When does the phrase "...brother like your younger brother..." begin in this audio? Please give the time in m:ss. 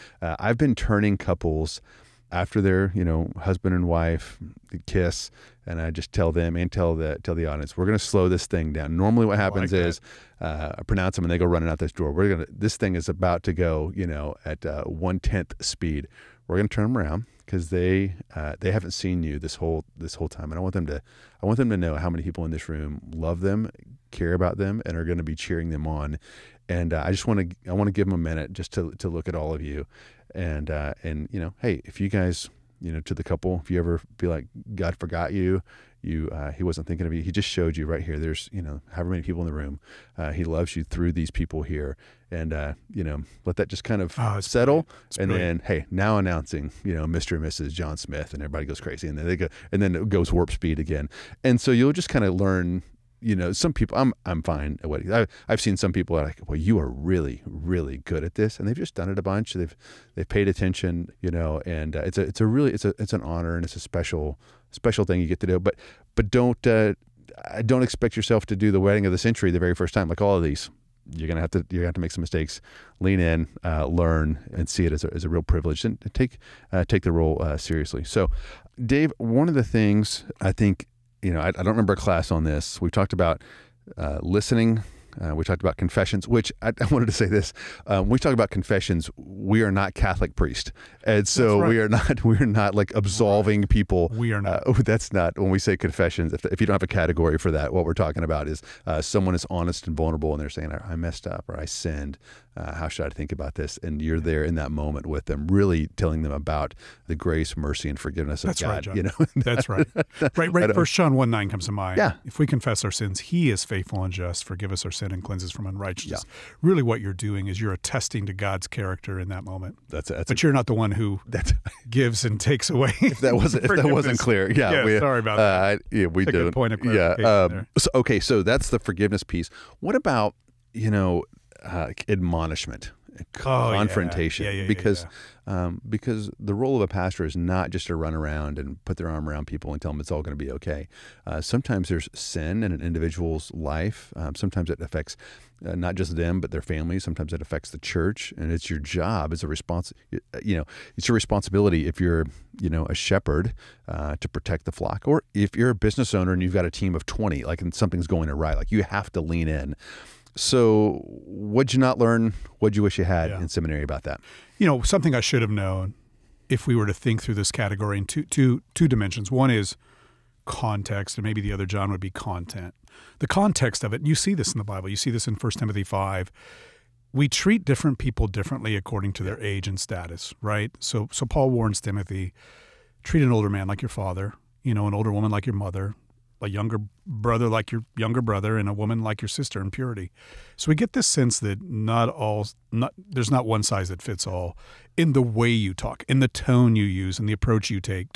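3:07.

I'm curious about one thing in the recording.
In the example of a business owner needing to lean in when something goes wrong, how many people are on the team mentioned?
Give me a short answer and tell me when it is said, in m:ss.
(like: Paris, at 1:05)
20, at 2:37.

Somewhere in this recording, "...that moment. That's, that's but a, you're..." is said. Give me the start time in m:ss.
1:59.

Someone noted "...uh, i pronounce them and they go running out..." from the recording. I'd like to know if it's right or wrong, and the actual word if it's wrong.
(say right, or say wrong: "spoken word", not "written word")
right.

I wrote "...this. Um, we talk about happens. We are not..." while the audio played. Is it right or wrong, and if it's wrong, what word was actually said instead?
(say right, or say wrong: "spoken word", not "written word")
wrong: "confessions", not "happens".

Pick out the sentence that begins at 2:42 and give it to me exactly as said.
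What'd you wish you had yeah.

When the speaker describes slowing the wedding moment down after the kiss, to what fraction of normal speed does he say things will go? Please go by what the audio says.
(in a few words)
one tenth.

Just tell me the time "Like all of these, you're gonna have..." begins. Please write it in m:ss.
1:10.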